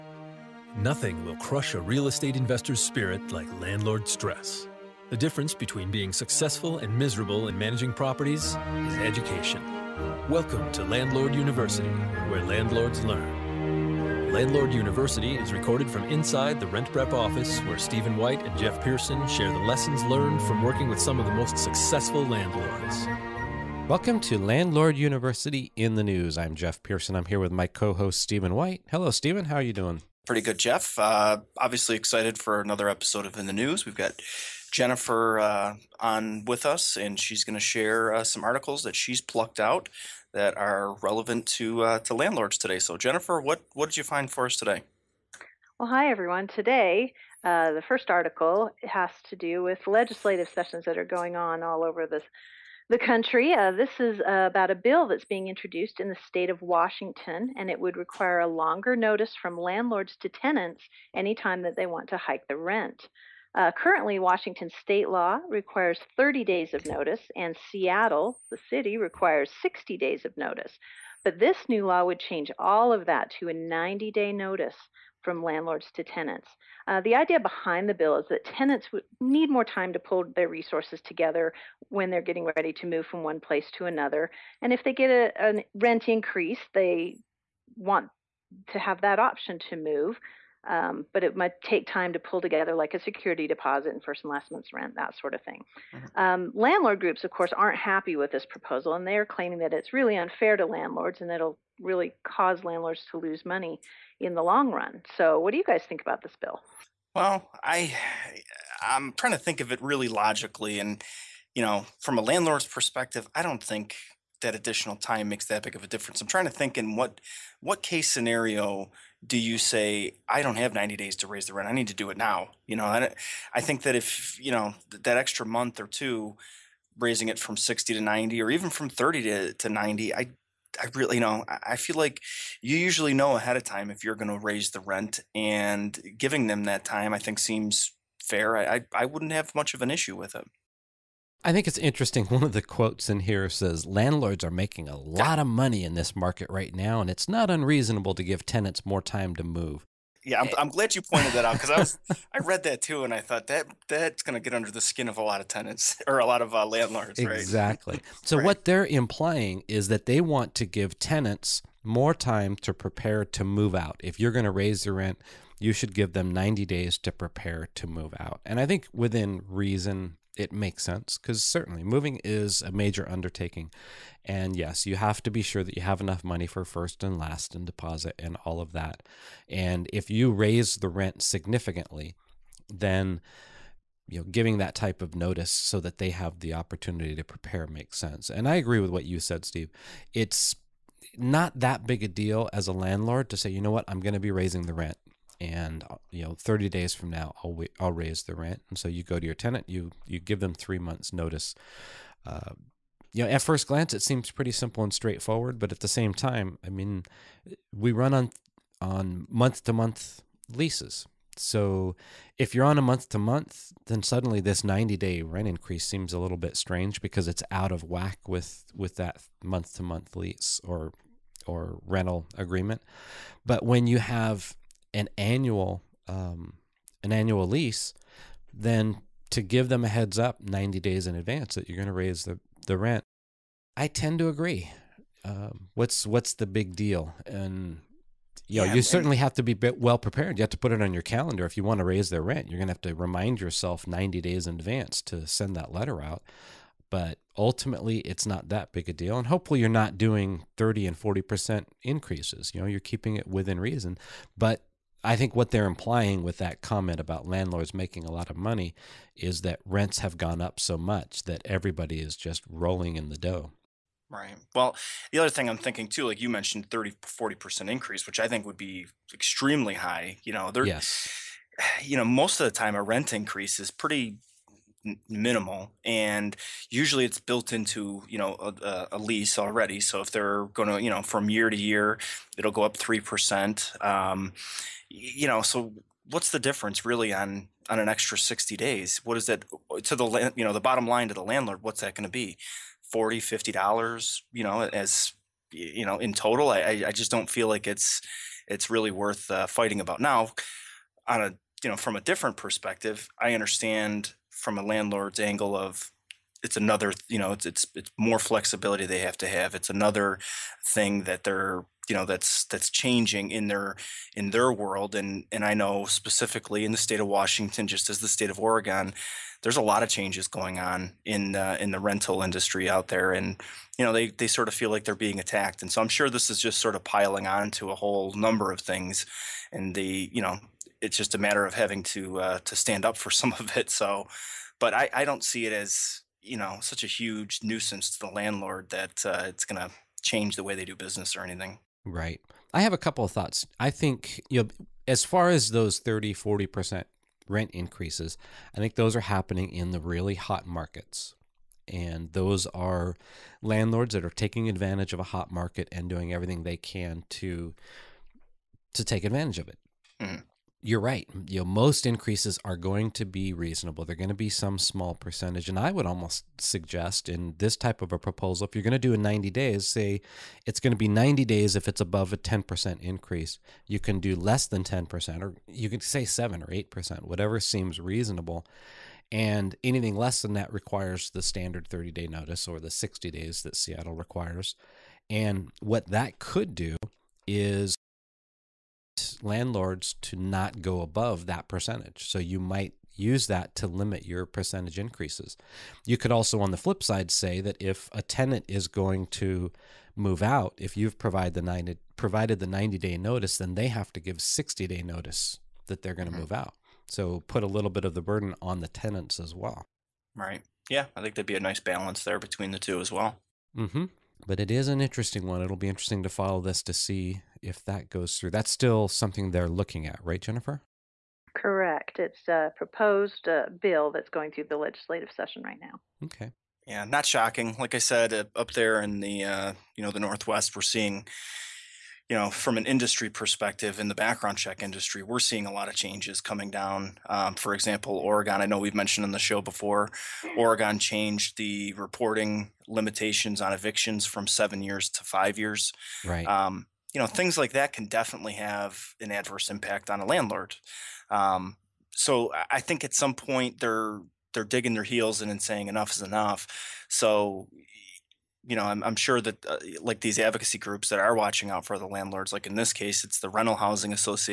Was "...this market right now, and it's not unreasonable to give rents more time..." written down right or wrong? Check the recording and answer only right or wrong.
wrong.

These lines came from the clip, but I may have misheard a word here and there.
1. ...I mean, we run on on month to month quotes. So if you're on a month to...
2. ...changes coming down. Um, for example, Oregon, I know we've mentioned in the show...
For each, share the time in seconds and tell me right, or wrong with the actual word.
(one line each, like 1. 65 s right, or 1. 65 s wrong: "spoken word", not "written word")
1. 206 s wrong: "leases", not "quotes"
2. 435 s right.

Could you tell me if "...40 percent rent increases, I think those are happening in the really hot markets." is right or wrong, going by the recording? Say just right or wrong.
right.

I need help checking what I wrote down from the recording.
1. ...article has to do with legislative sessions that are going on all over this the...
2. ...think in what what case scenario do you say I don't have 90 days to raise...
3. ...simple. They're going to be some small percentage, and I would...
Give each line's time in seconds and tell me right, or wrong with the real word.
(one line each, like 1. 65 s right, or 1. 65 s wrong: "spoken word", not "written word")
1. 48 s right
2. 116 s right
3. 363 s wrong: "reasonable", not "simple".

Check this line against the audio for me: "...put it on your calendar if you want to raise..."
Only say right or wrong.
right.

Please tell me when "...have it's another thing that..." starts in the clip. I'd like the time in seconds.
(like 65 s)
309 s.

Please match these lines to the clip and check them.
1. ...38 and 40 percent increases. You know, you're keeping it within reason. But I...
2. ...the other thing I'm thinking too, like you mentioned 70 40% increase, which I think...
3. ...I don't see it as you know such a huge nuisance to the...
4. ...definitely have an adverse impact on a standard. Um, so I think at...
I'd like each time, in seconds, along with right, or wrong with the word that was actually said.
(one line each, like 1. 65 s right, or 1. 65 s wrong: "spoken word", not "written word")
1. 250 s wrong: "30", not "38"
2. 265 s wrong: "30", not "70"
3. 334 s right
4. 447 s wrong: "landlord", not "standard".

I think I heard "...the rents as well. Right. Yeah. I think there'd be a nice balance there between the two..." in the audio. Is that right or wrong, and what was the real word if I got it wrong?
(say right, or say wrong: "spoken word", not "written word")
wrong: "tenants", not "rents".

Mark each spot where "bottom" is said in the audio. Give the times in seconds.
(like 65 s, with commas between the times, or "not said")
290 s.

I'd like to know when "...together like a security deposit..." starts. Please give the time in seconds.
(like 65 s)
92 s.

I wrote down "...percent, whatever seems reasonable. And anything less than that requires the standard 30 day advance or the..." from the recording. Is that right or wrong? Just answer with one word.
wrong.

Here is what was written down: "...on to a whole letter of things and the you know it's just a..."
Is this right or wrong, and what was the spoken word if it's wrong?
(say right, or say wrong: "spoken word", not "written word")
wrong: "number", not "letter".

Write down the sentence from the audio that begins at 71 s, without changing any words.
But this new law would change all of that to a 90 day notice from landlords to tenants.